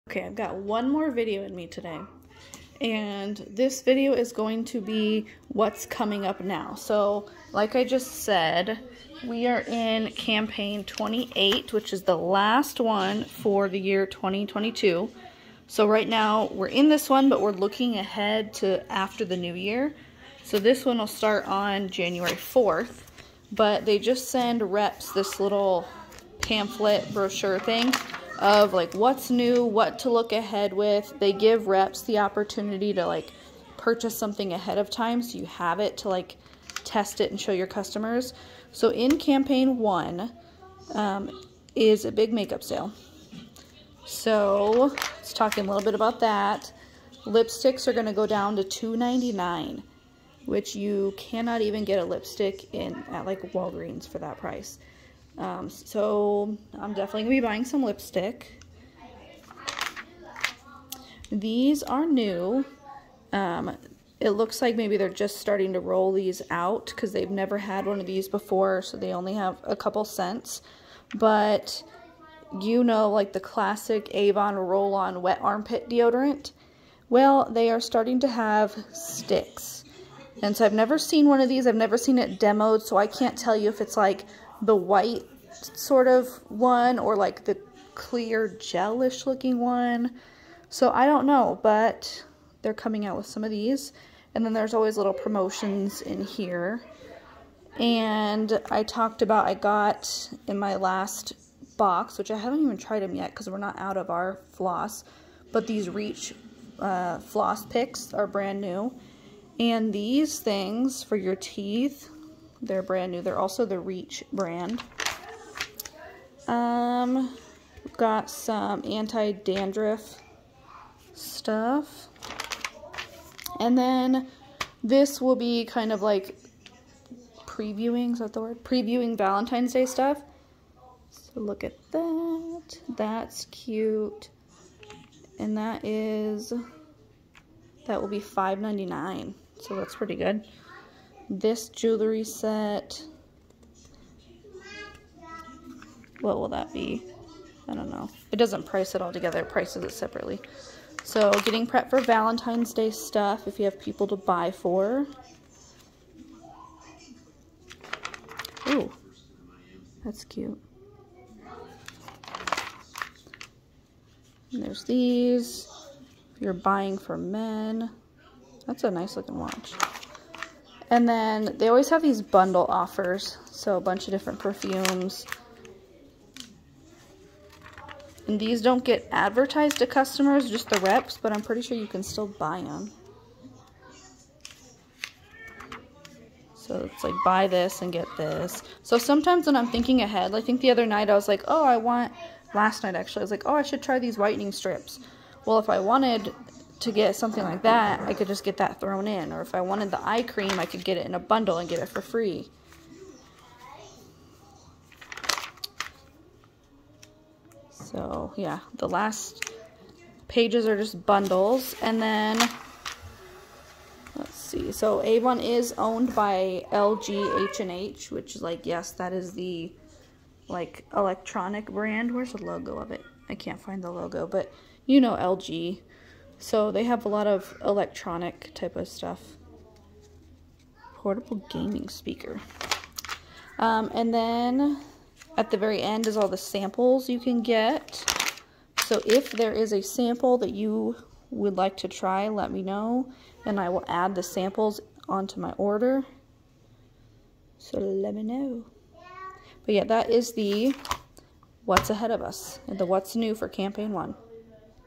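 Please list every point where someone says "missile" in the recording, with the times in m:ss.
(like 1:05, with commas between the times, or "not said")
not said.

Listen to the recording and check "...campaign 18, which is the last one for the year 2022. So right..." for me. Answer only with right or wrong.
wrong.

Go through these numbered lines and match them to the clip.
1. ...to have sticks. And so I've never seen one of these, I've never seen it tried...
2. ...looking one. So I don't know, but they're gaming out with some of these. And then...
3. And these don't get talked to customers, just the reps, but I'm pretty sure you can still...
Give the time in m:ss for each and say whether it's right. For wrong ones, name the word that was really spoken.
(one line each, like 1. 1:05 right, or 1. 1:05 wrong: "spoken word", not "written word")
1. 1:18 wrong: "demoed", not "tried"
2. 1:29 wrong: "coming", not "gaming"
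3. 2:58 wrong: "advertised", not "talked".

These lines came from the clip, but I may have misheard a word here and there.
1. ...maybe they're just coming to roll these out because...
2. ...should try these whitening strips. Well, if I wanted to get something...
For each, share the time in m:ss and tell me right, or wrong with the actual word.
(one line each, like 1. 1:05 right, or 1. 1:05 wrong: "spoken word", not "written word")
1. 1:04 wrong: "starting", not "coming"
2. 3:13 right.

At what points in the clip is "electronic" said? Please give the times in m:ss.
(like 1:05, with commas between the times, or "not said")
3:40, 3:47.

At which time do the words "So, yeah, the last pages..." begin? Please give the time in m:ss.
3:27.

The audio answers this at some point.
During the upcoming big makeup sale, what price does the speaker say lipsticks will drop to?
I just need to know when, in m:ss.
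0:48.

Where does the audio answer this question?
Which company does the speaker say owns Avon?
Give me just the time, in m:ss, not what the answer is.
3:36.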